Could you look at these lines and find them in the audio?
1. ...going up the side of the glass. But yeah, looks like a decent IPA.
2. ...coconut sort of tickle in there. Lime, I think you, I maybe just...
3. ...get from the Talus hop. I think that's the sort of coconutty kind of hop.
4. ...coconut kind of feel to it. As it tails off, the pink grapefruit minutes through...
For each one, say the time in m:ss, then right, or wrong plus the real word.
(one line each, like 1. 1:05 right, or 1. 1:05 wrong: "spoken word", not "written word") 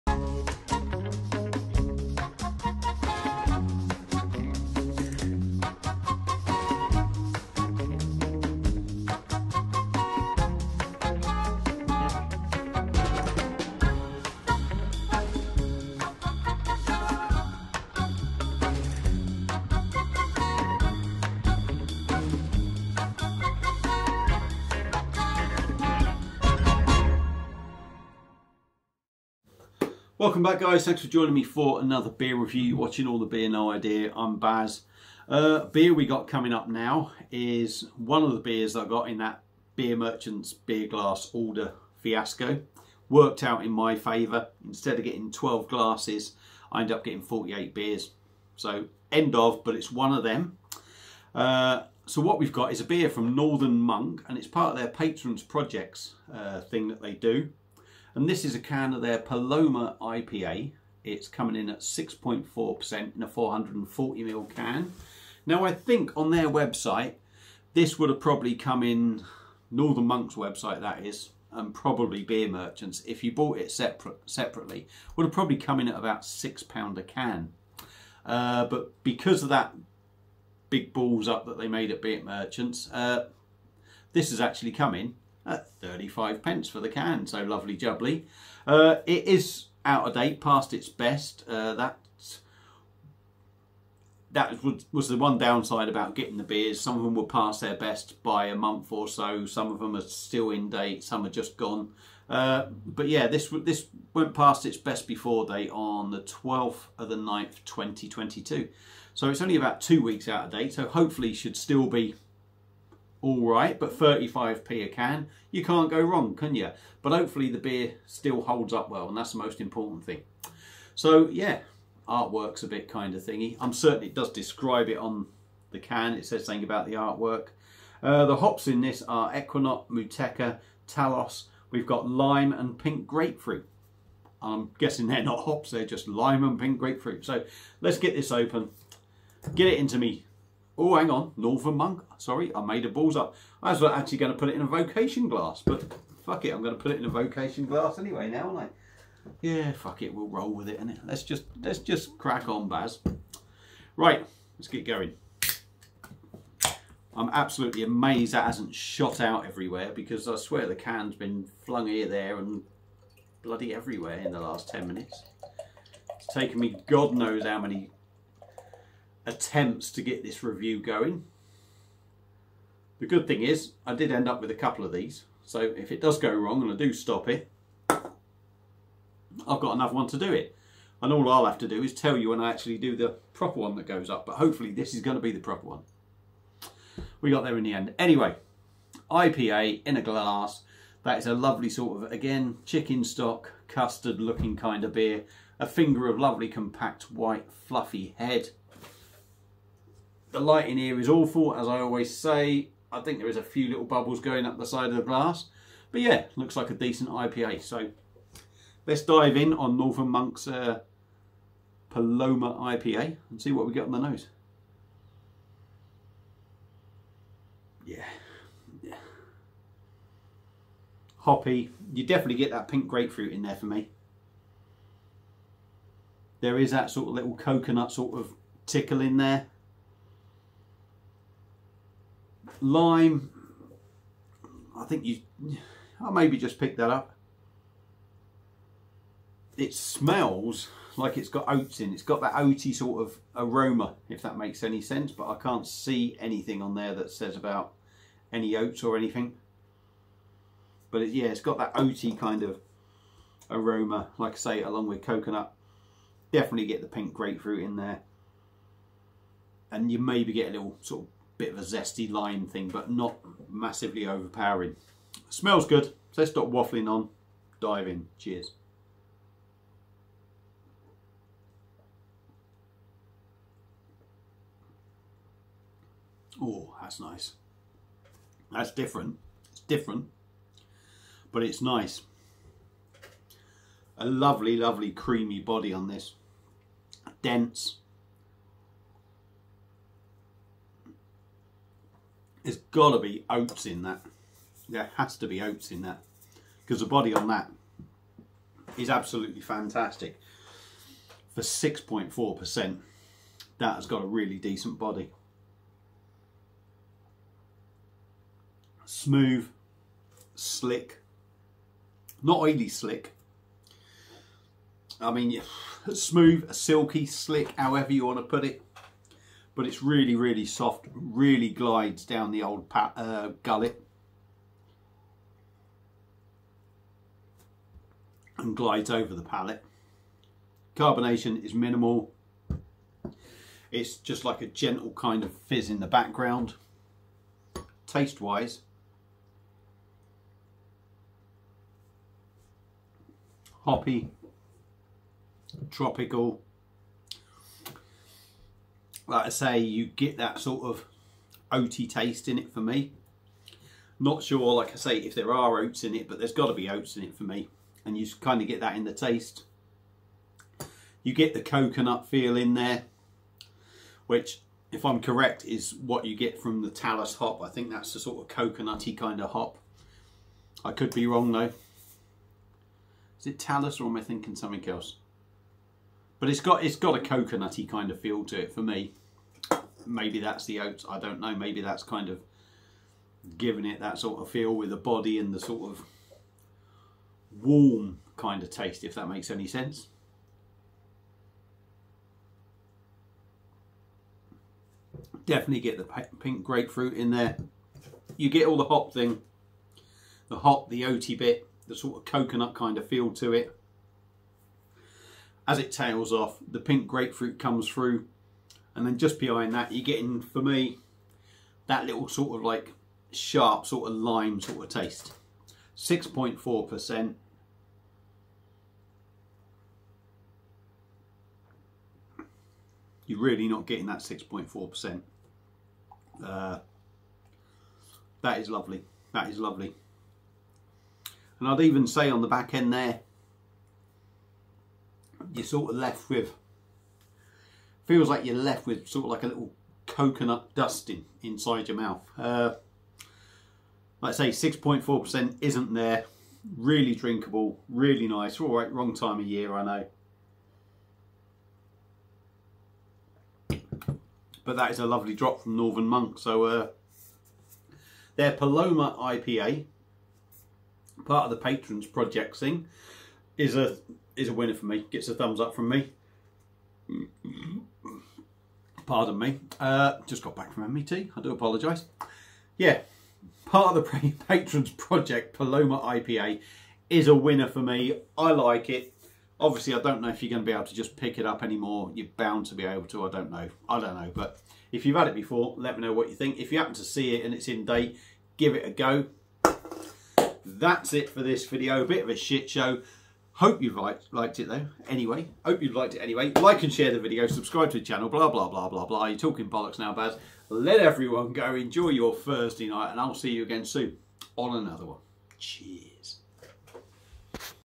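1. 3:24 right
2. 3:47 right
3. 6:06 right
4. 6:42 wrong: "comes", not "minutes".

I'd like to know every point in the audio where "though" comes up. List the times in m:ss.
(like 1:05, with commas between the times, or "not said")
6:11, 8:14.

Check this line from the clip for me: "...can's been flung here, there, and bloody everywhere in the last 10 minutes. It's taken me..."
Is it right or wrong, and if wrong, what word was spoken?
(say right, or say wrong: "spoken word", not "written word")
right.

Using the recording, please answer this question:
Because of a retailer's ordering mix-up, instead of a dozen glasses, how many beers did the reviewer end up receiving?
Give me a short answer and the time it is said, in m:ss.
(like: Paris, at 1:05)
48, at 0:47.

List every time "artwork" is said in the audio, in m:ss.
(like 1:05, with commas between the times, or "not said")
2:02, 2:06.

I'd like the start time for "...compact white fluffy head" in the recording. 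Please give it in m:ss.
3:16.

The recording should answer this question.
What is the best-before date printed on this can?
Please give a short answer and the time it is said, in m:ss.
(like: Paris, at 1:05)
12/09/2022, at 1:46.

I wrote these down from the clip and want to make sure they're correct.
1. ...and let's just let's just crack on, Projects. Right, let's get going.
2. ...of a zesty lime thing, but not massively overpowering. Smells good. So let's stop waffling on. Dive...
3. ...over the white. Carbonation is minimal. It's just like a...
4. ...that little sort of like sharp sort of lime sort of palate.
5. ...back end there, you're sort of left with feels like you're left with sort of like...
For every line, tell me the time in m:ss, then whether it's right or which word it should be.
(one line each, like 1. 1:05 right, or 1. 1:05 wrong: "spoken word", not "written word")
1. 2:30 wrong: "Baz", not "Projects"
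2. 4:21 right
3. 5:28 wrong: "palate", not "white"
4. 6:51 wrong: "taste", not "palate"
5. 7:12 right.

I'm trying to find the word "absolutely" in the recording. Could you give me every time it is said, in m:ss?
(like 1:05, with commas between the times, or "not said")
2:37, 4:58.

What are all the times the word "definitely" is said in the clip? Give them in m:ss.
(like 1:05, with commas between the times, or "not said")
3:42, 4:16, 6:35.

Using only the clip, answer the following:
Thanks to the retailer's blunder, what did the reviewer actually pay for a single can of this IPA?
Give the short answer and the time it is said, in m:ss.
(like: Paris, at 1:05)
35 pence, at 1:25.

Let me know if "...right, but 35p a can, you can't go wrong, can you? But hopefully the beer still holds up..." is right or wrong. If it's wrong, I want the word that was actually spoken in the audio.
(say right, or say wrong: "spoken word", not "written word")
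right.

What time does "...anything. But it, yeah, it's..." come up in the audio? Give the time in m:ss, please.
4:08.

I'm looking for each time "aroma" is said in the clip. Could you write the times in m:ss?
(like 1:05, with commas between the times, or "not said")
4:03, 4:13.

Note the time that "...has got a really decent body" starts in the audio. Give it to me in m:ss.
5:03.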